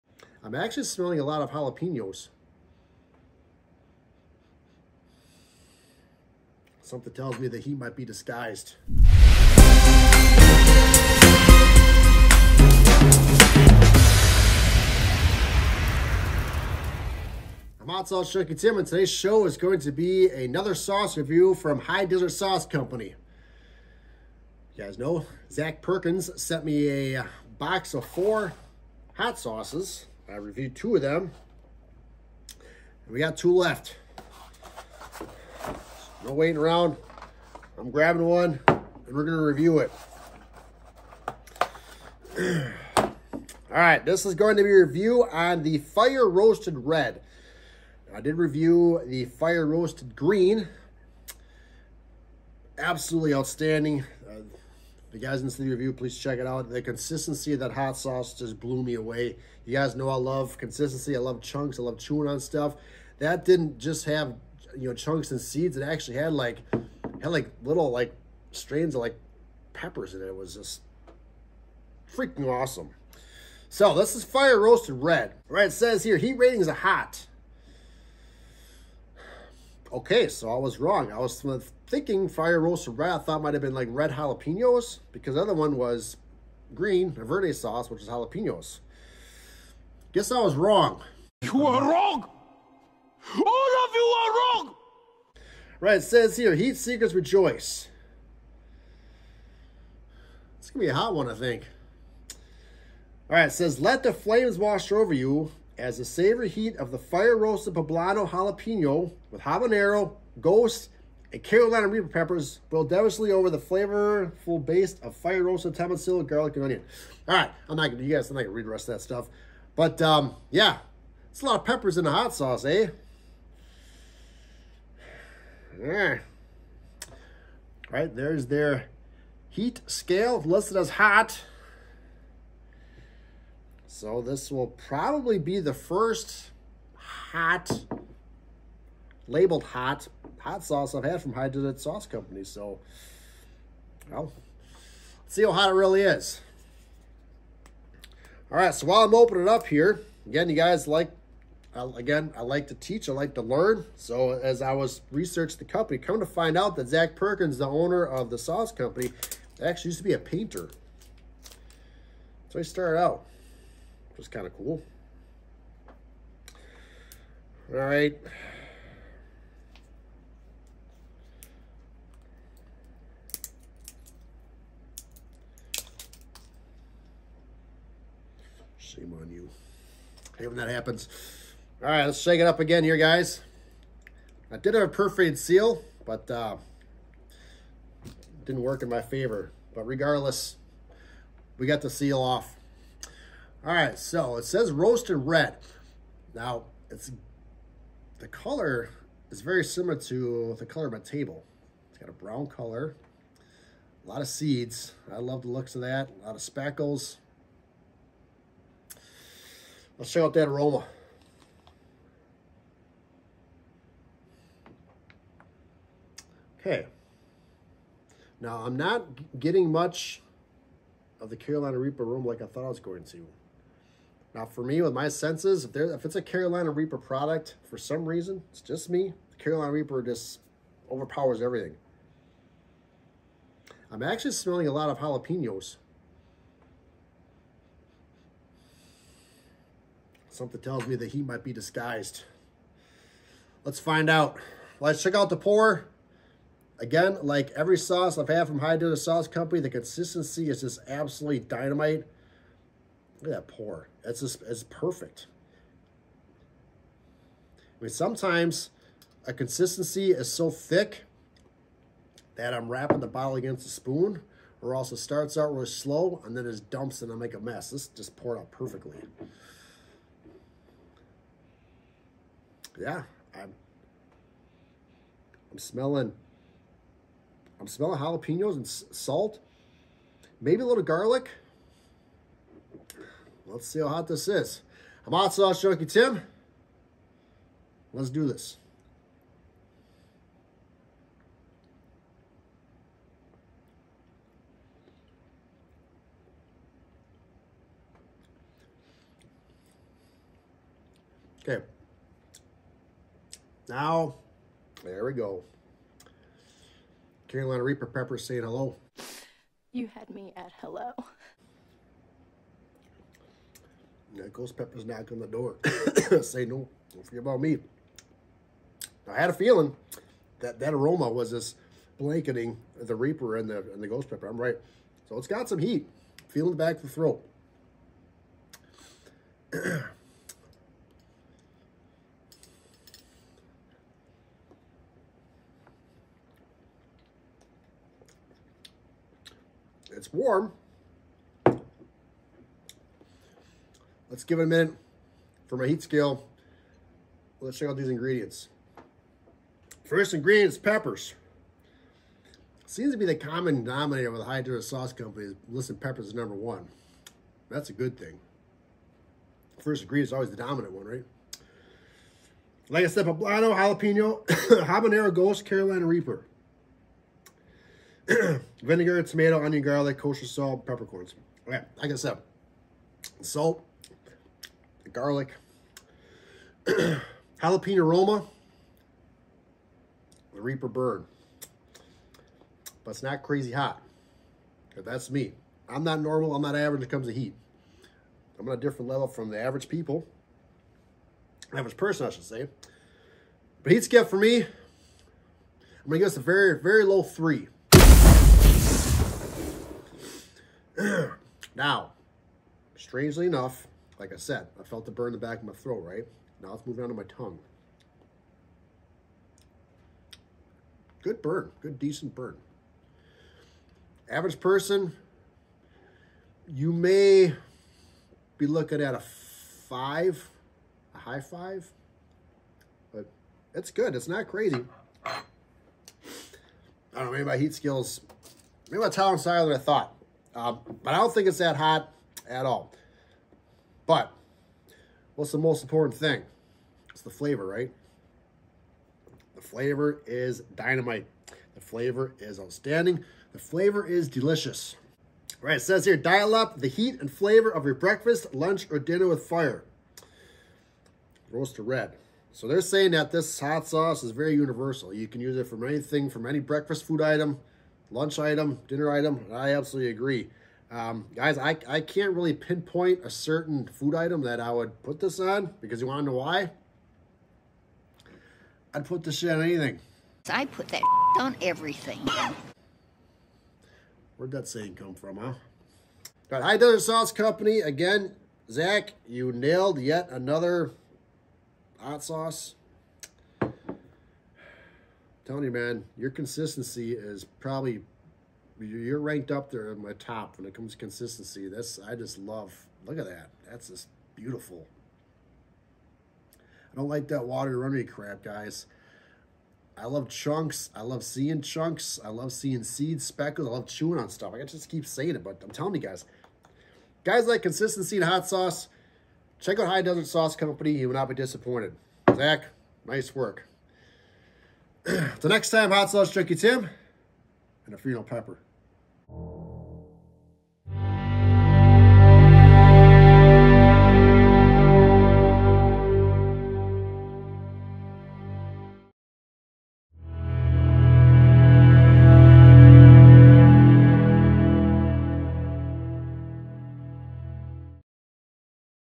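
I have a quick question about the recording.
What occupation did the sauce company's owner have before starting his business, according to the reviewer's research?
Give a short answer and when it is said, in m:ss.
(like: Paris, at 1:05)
Painter, at 2:40.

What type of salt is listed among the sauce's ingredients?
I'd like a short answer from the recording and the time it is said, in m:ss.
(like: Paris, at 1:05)
Kosher salt, at 6:09.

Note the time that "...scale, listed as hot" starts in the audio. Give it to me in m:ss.
2:09.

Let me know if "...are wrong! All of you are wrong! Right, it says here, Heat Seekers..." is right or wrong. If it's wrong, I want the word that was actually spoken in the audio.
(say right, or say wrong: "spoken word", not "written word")
right.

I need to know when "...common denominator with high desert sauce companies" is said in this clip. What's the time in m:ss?
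5:53.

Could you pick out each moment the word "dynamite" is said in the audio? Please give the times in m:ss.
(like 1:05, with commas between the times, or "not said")
4:11, 7:20.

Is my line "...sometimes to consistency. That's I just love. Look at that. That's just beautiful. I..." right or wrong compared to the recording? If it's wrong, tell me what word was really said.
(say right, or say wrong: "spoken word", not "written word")
wrong: "comes", not "sometimes".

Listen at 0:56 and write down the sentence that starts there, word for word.
The consistency of that hot sauce just blew me away.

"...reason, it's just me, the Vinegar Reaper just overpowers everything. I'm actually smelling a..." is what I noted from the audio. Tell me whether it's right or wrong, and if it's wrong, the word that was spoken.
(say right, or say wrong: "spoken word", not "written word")
wrong: "Carolina", not "Vinegar".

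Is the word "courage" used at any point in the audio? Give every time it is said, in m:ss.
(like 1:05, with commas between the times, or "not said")
not said.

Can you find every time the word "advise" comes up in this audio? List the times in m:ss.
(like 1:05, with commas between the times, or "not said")
not said.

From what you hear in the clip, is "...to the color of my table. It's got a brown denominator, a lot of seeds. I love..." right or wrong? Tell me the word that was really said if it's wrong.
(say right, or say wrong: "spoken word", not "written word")
wrong: "color", not "denominator".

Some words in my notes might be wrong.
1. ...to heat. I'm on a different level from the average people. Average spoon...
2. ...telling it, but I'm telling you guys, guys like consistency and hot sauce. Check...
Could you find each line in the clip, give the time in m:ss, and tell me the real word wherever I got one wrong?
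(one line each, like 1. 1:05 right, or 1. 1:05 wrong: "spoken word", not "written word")
1. 6:27 wrong: "person", not "spoon"
2. 8:24 wrong: "saying", not "telling".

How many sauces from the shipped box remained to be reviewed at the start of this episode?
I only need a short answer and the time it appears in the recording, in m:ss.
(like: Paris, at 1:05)
2, at 0:33.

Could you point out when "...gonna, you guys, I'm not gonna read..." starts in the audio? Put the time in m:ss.
1:57.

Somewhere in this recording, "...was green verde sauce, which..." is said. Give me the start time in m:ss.
1:25.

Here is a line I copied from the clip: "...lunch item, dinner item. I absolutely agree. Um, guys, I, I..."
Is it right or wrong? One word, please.
right.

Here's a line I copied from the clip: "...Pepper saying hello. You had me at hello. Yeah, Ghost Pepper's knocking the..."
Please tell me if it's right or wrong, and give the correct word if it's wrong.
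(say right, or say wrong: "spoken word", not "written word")
right.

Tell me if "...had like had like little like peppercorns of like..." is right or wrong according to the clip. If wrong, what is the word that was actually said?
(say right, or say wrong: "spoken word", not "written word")
wrong: "strains", not "peppercorns".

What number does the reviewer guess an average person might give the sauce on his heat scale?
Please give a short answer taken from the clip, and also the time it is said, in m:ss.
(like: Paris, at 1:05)
5, at 6:58.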